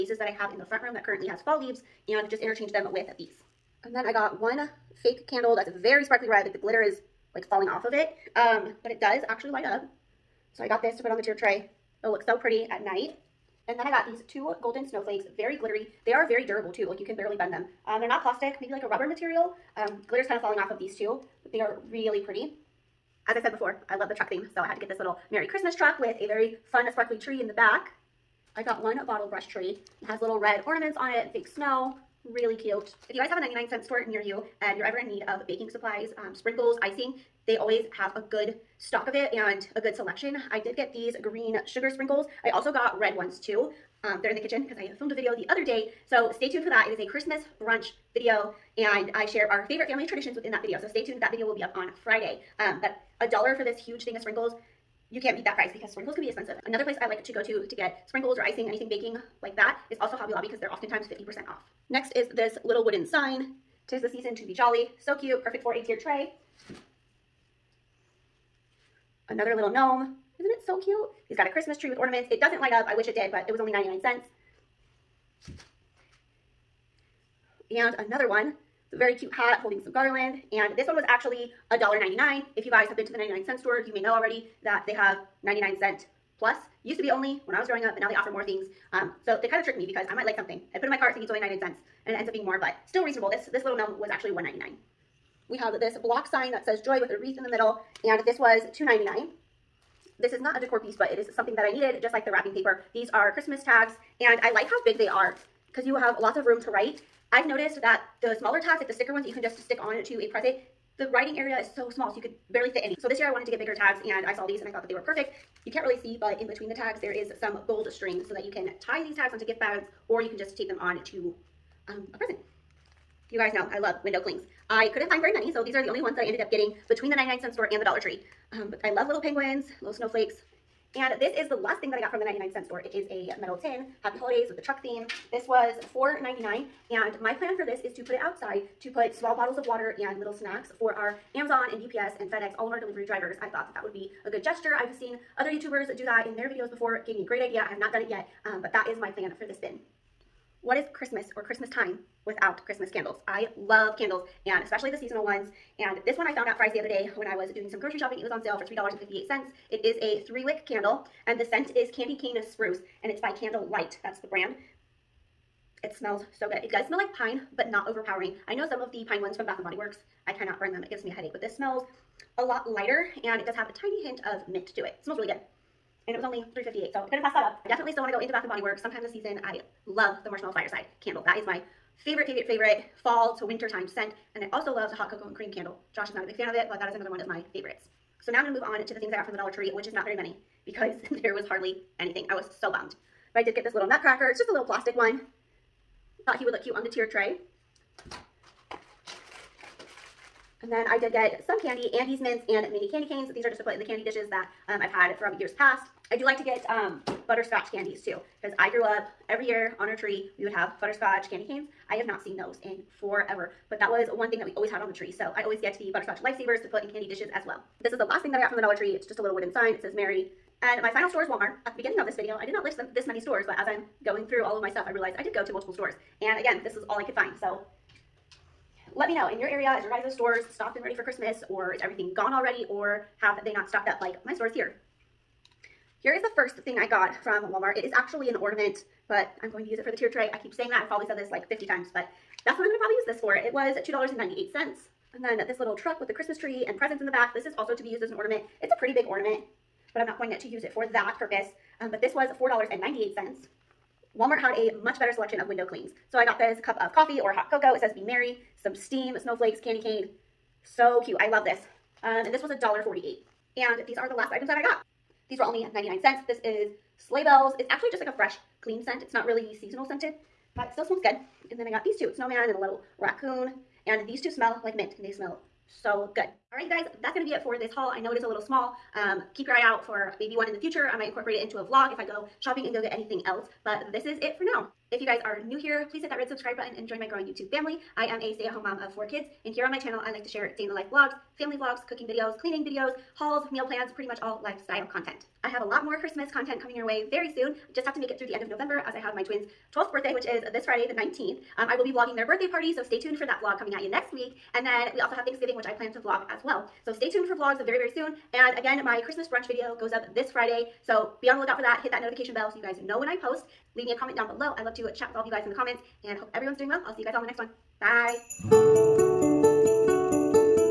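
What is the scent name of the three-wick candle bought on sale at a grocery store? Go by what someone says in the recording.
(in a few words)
Candy Cane Spruce.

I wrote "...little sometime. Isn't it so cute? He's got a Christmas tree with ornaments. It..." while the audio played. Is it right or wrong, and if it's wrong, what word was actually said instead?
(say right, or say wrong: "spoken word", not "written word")
wrong: "gnome", not "sometime".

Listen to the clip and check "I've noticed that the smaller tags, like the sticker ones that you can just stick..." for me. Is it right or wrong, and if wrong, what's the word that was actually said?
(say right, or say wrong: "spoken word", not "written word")
right.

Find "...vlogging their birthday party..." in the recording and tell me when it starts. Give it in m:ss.
5:01.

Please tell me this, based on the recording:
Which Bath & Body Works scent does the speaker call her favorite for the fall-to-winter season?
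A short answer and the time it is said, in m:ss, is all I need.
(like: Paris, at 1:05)
Marshmallow Fireside, at 3:00.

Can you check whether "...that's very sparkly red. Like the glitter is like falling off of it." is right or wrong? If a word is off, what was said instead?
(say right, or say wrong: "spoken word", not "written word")
right.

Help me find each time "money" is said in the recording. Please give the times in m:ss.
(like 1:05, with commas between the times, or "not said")
not said.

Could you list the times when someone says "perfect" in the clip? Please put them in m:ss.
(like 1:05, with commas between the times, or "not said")
1:05, 1:55.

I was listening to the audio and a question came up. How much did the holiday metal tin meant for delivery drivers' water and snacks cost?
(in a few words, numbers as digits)
$4.99.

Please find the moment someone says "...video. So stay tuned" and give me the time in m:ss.
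0:50.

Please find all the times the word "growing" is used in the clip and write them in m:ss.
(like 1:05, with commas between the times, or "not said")
1:27, 4:47.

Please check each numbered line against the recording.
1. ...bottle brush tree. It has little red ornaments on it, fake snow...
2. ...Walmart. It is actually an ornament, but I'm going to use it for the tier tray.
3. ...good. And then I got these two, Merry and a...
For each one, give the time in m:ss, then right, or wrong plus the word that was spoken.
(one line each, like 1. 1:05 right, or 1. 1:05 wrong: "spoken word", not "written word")
1. 0:29 right
2. 3:57 right
3. 4:31 wrong: "Snowman", not "Merry".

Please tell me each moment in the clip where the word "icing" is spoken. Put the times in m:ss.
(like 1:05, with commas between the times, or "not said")
0:36, 0:58.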